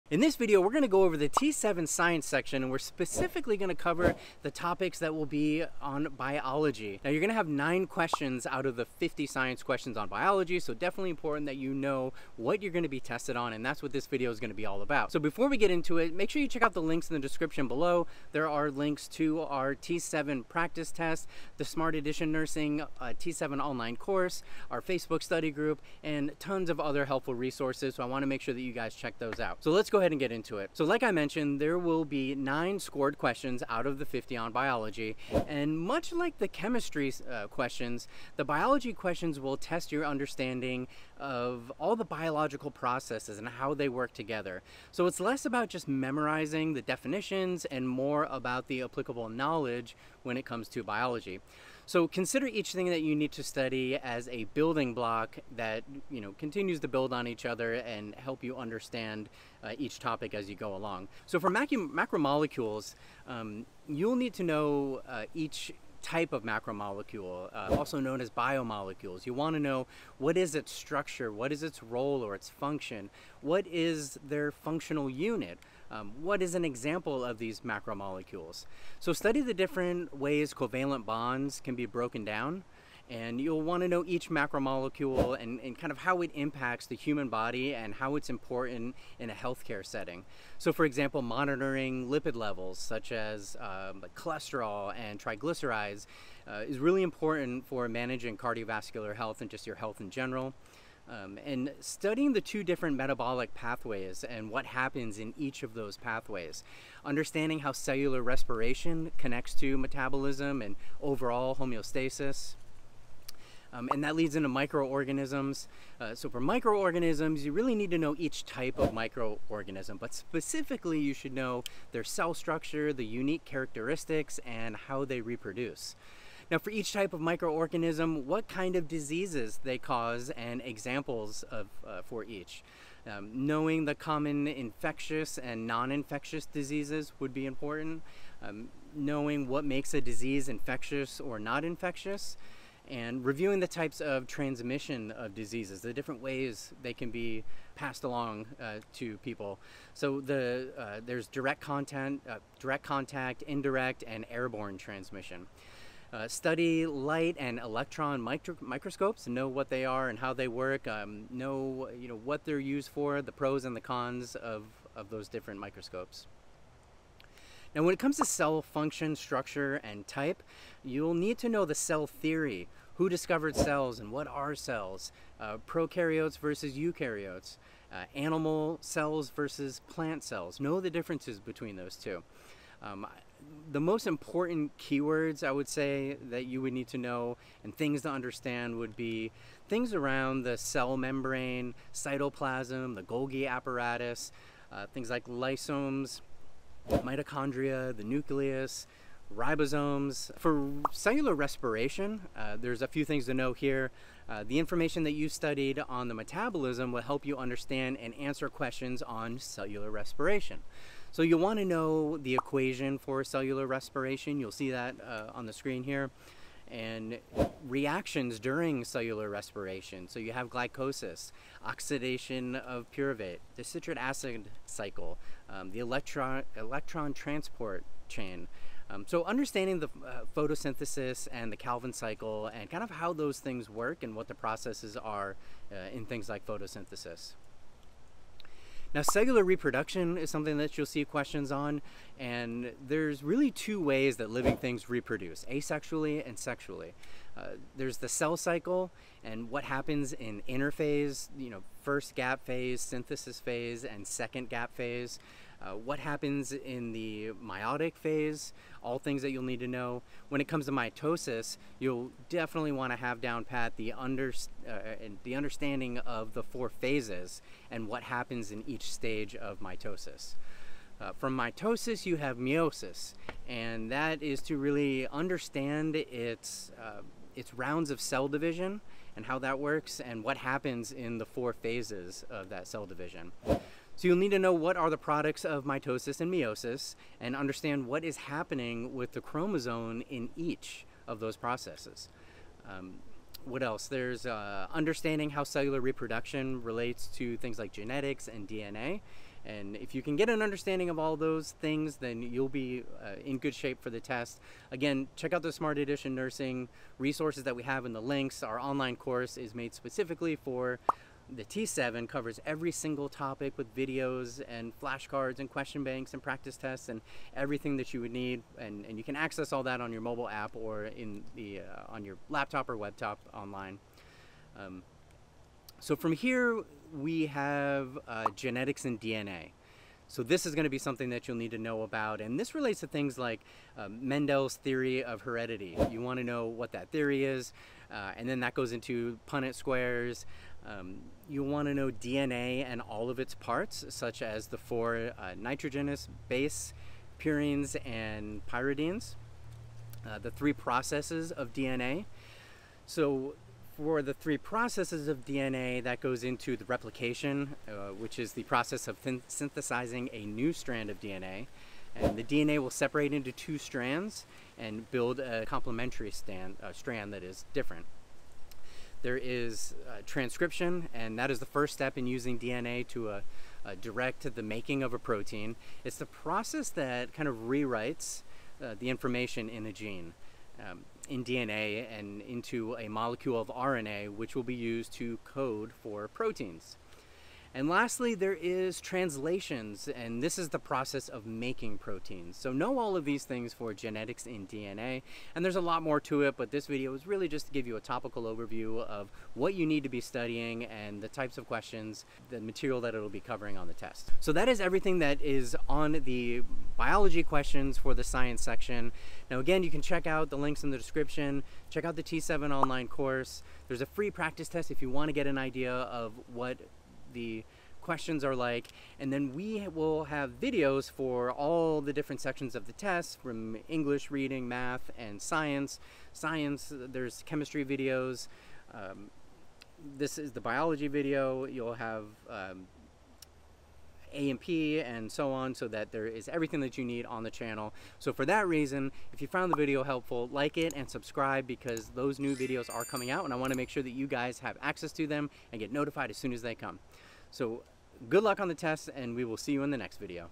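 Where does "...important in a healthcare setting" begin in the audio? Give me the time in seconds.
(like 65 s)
88 s.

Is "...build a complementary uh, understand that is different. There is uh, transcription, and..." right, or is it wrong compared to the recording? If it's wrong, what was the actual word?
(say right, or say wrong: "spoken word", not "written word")
wrong: "strand", not "understand".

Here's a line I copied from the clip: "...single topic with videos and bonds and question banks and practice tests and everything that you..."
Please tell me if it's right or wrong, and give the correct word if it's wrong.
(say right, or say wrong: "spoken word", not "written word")
wrong: "flashcards", not "bonds".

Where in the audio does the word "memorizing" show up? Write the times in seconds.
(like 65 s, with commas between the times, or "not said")
45 s.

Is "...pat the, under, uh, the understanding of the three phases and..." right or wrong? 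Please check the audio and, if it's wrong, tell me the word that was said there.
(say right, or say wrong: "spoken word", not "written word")
wrong: "four", not "three".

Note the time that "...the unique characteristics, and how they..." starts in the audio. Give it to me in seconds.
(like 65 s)
122 s.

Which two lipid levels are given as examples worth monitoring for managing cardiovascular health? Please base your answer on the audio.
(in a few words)
cholesterol and triglycerides.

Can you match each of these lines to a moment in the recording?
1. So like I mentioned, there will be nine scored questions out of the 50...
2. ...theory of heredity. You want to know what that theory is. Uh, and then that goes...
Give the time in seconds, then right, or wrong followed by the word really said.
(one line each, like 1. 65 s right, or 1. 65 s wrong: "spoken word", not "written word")
1. 30 s right
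2. 334 s right.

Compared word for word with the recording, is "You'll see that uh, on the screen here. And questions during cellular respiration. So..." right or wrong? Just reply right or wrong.
wrong.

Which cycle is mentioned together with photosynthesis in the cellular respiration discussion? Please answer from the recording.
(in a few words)
Calvin cycle.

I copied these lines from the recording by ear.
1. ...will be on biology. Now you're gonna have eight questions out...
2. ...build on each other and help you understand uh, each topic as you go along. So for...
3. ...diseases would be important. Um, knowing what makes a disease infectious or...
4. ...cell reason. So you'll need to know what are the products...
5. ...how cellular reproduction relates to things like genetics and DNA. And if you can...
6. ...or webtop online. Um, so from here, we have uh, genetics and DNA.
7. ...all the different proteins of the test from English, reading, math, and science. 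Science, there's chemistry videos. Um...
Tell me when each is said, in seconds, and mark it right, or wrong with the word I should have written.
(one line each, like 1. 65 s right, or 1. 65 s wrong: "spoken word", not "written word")
1. 5 s wrong: "nine", not "eight"
2. 56 s right
3. 136 s right
4. 282 s wrong: "division", not "reason"
5. 295 s right
6. 322 s right
7. 421 s wrong: "sections", not "proteins".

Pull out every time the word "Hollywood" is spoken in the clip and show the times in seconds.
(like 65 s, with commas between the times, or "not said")
not said.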